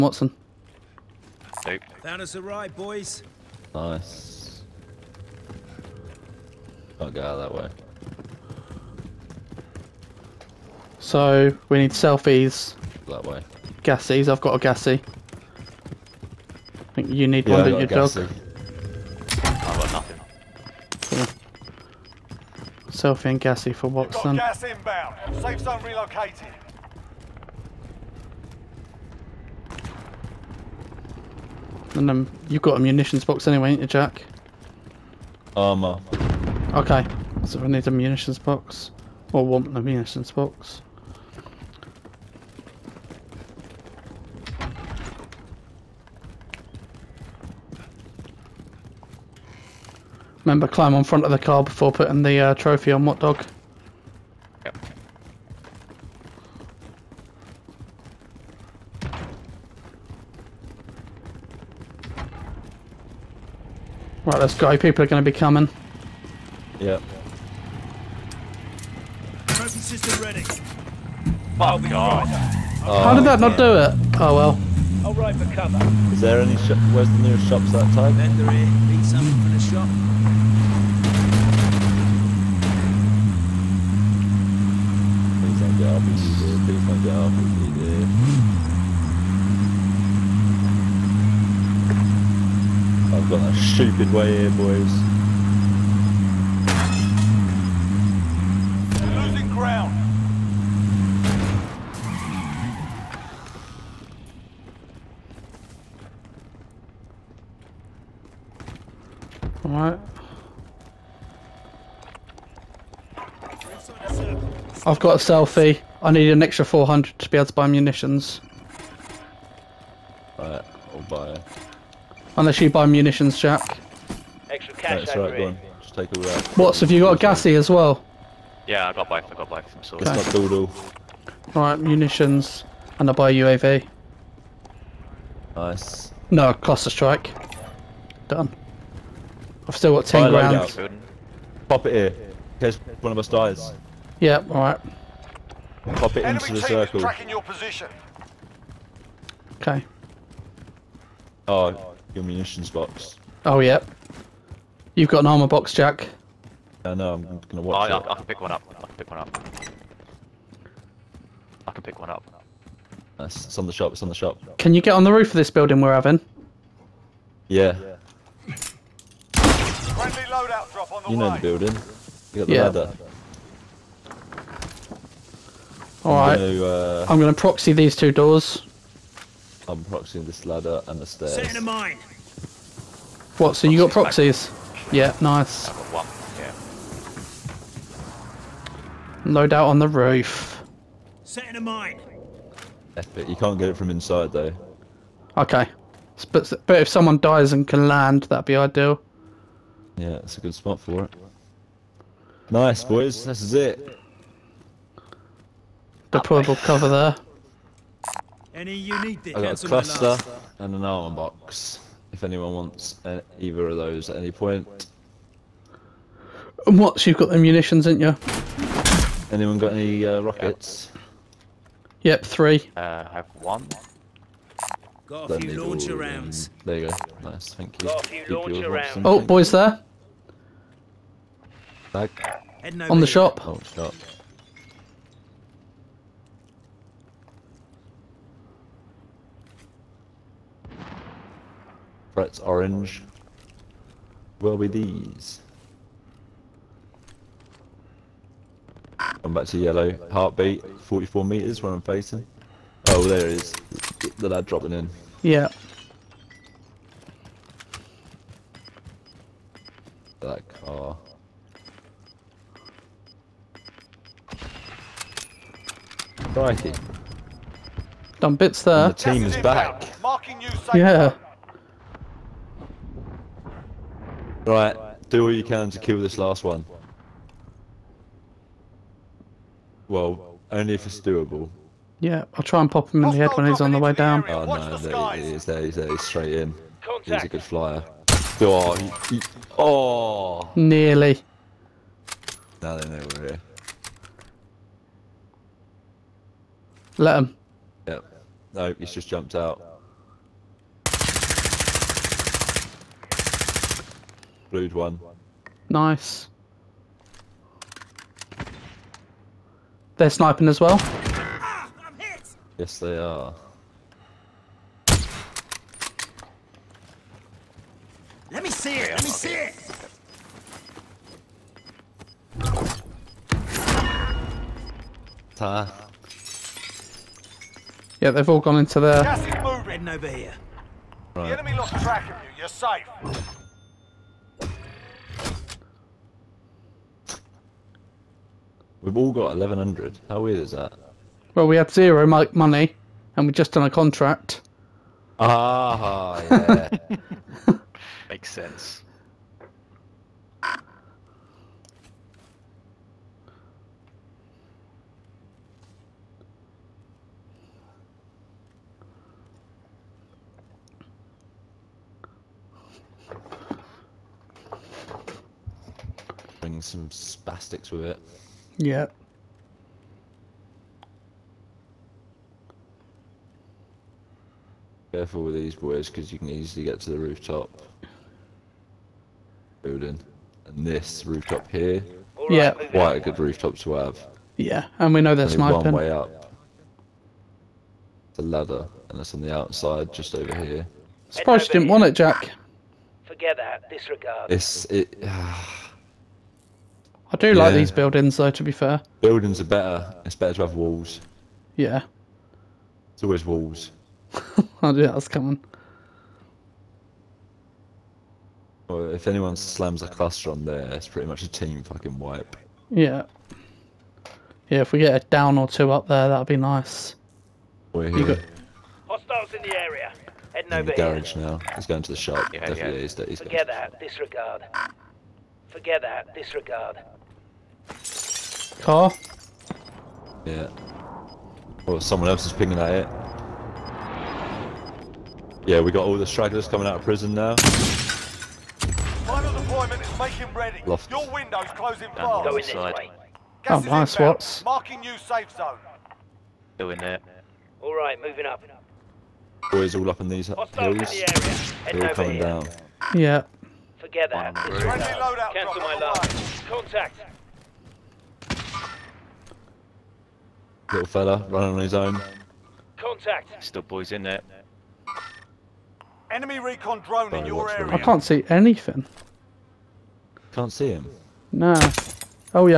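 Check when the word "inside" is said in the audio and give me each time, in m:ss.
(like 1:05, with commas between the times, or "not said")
3:13, 7:22.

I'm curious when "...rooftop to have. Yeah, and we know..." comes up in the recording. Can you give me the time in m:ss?
6:23.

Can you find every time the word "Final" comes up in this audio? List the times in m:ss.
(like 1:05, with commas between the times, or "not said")
7:17.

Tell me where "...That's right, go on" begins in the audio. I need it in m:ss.
2:05.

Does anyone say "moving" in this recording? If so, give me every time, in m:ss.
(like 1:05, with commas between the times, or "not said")
5:29, 7:28.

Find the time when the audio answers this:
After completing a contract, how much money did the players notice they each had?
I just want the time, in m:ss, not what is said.
5:39.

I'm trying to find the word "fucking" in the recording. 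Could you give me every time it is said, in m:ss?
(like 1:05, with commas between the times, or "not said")
6:51.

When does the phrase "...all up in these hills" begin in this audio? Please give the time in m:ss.
7:29.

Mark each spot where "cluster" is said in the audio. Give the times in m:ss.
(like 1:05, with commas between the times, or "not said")
2:16, 3:29, 6:49.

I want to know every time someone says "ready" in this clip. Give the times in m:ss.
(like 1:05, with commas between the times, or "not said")
1:10, 7:20.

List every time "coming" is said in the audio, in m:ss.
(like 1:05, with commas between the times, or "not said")
1:05, 6:45, 7:16, 7:31.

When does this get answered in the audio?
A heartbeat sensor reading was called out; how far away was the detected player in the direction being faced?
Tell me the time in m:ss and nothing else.
4:10.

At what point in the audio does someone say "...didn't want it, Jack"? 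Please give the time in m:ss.
6:31.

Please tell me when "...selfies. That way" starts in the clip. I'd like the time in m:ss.
0:11.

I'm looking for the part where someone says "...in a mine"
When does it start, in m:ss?
3:11.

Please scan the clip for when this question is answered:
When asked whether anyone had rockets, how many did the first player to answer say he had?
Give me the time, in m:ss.
3:42.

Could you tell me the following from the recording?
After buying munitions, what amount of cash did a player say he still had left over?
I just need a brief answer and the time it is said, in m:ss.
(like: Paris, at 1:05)
10 grand, at 2:20.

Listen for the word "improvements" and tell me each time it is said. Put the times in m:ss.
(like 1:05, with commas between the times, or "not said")
not said.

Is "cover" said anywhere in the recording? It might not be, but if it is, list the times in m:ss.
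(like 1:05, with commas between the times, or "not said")
1:15, 3:26.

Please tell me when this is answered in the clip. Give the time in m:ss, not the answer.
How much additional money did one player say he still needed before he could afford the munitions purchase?
1:56.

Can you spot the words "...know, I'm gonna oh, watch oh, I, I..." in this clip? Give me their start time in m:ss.
2:36.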